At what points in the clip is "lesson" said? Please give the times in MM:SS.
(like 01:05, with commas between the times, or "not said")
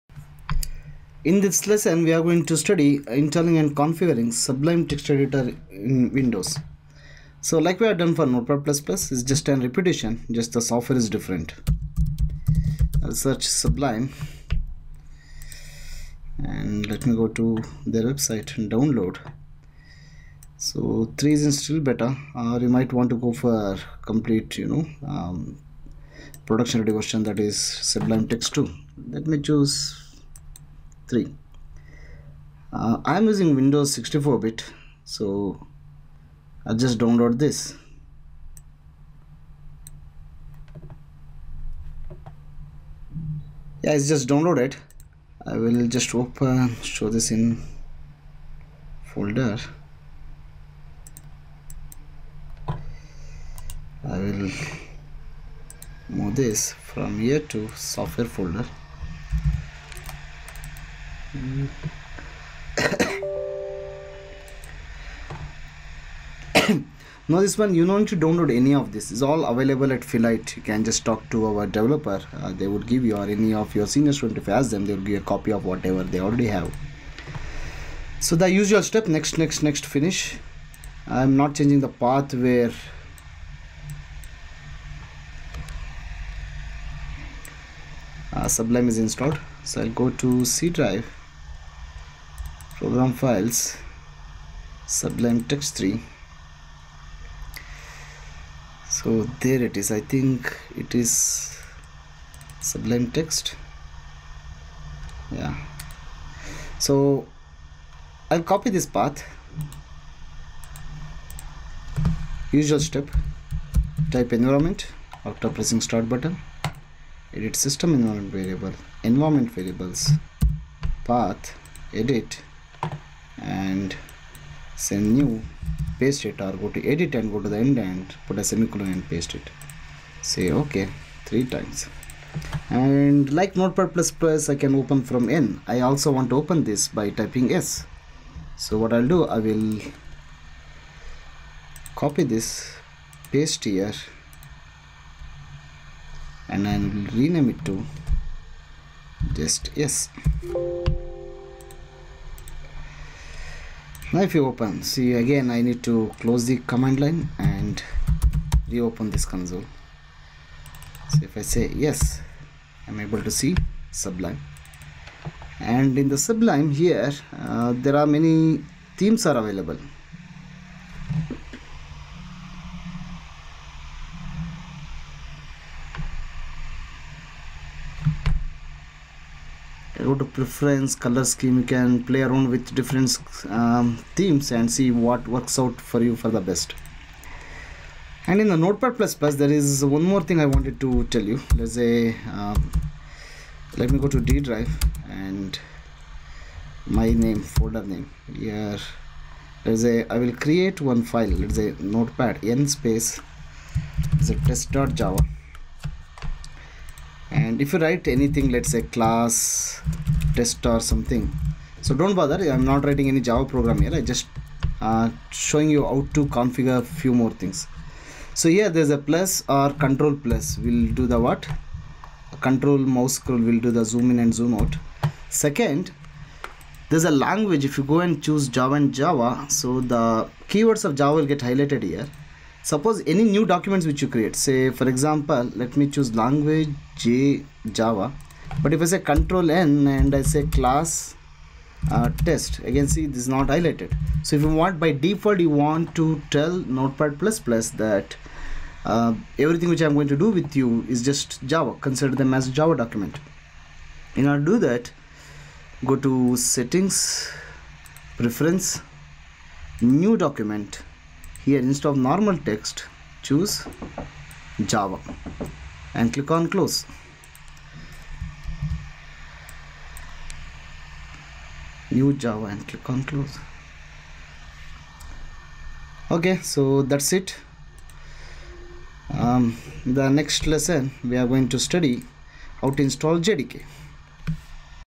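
00:01, 04:40.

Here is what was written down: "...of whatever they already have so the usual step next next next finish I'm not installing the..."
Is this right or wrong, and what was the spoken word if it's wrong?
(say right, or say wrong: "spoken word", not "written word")
wrong: "changing", not "installing".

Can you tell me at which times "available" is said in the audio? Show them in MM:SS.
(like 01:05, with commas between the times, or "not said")
01:09, 02:49.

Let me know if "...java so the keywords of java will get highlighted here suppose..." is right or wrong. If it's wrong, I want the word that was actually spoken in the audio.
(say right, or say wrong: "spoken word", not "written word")
right.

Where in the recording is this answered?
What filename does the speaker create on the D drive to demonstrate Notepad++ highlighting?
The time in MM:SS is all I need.
03:24.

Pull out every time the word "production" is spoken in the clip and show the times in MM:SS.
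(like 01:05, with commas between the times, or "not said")
00:26.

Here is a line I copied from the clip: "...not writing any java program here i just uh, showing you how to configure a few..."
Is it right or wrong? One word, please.
right.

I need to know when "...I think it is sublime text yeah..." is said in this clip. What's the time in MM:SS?
01:39.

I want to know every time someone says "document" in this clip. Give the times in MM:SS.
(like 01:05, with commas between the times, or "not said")
03:53, 04:12, 04:20.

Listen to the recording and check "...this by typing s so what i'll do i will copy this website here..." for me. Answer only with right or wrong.
wrong.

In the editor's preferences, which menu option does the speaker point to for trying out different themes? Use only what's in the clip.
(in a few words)
color scheme.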